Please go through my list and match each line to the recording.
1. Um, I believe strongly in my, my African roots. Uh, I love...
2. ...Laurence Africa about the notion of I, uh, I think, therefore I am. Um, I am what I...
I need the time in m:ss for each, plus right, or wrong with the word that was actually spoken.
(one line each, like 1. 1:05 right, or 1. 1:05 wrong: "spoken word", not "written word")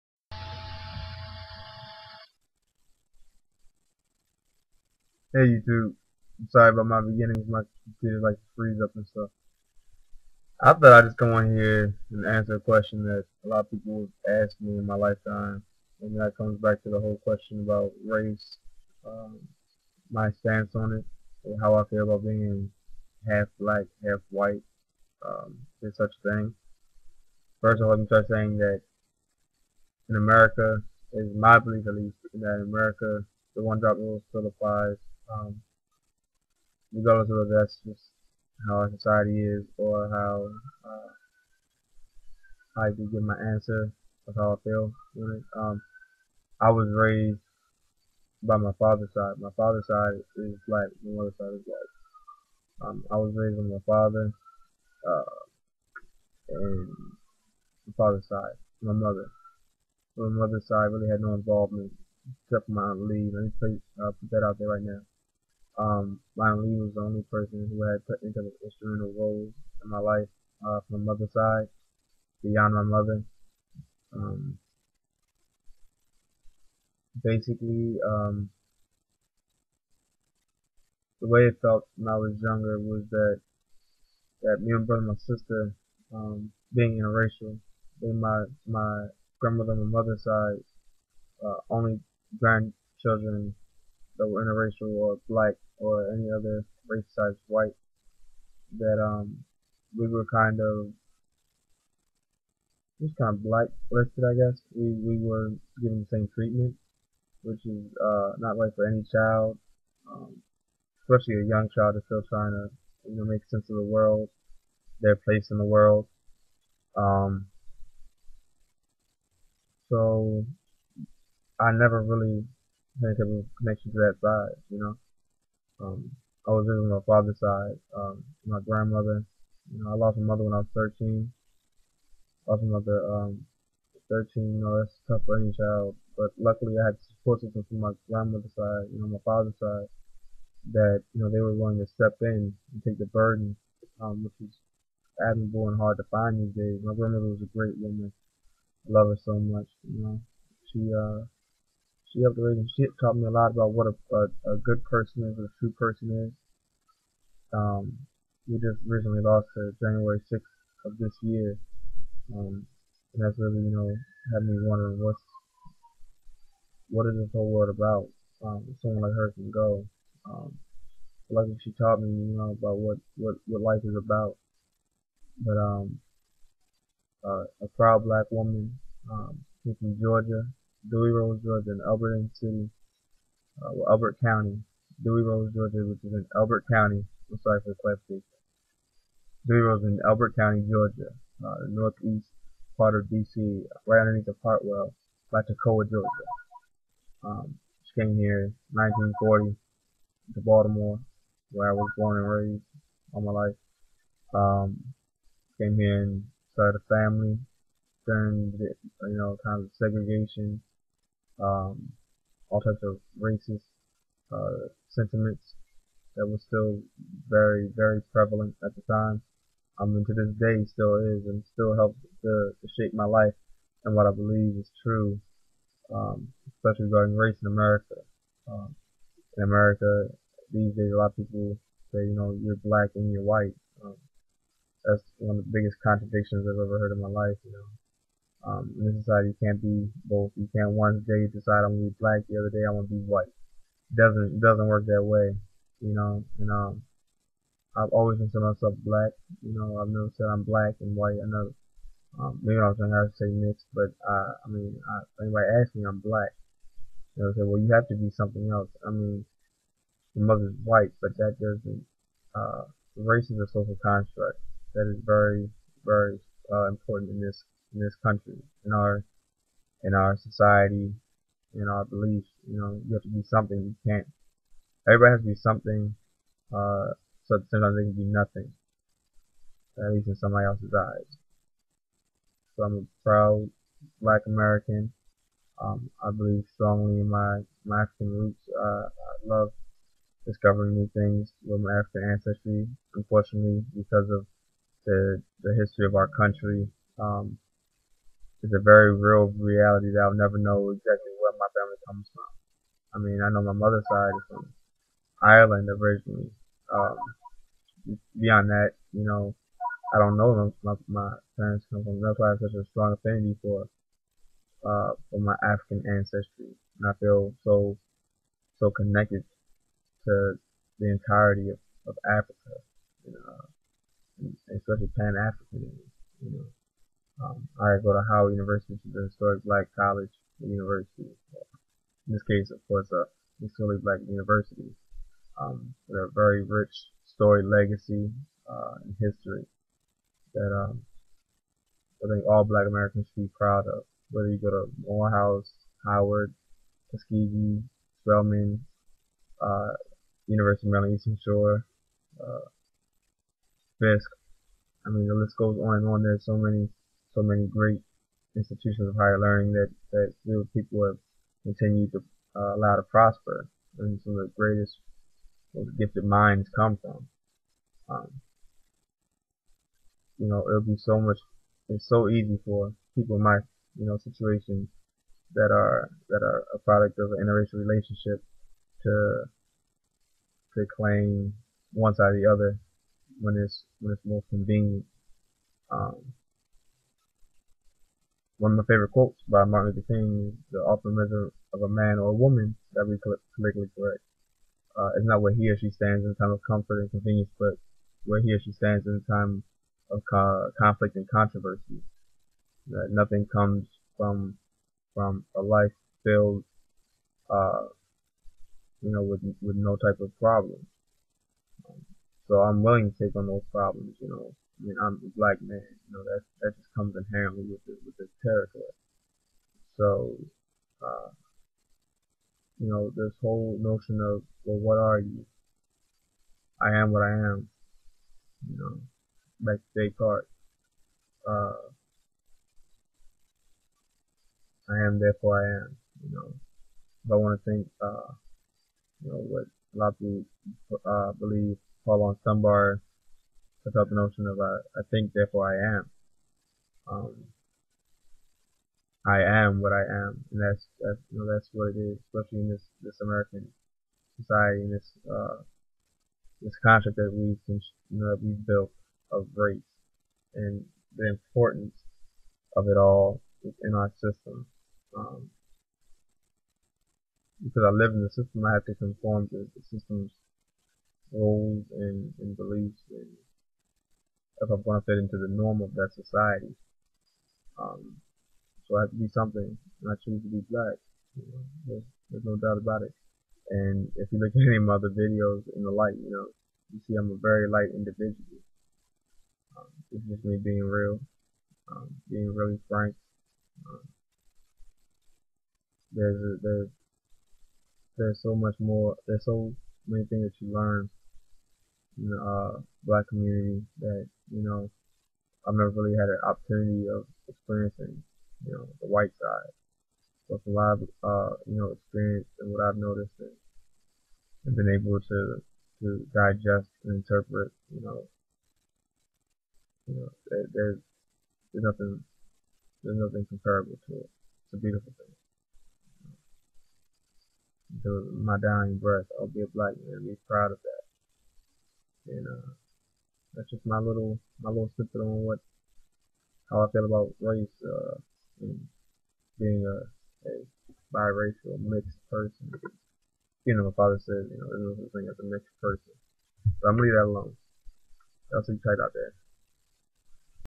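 1. 4:45 right
2. 7:21 wrong: "Dunbar", not "Africa".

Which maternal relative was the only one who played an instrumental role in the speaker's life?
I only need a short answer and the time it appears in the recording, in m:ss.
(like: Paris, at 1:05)
Aunt Lee, at 1:02.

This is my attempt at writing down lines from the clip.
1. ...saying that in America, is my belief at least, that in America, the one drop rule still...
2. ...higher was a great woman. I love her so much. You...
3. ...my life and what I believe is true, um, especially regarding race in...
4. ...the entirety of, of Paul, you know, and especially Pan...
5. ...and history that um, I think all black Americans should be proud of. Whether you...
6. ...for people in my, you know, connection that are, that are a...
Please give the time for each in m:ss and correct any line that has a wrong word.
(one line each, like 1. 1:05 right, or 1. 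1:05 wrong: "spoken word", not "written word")
1. 0:28 right
2. 2:26 wrong: "grandmother", not "higher"
3. 3:42 right
4. 5:20 wrong: "Africa", not "Paul"
5. 5:38 right
6. 6:12 wrong: "situation", not "connection".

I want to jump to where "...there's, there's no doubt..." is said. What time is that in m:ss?
8:01.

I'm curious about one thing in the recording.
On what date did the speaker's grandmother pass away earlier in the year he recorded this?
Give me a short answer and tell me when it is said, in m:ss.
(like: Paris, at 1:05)
January 6th, at 2:39.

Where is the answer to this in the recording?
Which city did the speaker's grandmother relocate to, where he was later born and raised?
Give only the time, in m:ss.
3:20.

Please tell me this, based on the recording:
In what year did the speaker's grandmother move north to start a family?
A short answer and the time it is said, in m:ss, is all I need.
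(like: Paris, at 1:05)
1940, at 3:18.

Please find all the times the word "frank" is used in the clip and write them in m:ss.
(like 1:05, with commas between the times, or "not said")
8:12.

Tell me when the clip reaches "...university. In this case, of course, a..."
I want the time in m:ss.
5:30.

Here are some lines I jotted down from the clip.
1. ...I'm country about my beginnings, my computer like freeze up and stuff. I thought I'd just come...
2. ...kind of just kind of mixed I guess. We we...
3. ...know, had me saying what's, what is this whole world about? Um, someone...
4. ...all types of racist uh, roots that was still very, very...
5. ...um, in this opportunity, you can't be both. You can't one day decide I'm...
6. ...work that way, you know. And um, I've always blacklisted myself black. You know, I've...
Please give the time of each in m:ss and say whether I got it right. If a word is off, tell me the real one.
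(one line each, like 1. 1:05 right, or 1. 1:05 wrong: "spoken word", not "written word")
1. 0:06 wrong: "sorry", not "country"
2. 1:40 wrong: "blacklisted", not "mixed"
3. 2:43 wrong: "wondering", not "saying"
4. 3:32 wrong: "sentiments", not "roots"
5. 3:58 wrong: "society", not "opportunity"
6. 4:04 wrong: "considered", not "blacklisted".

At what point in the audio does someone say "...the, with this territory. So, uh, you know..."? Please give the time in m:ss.
6:57.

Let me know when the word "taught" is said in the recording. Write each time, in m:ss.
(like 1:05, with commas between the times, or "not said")
2:32, 2:51.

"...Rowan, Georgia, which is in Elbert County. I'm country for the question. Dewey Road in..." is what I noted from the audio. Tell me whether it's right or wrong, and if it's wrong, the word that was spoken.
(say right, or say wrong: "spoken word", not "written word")
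wrong: "sorry", not "country".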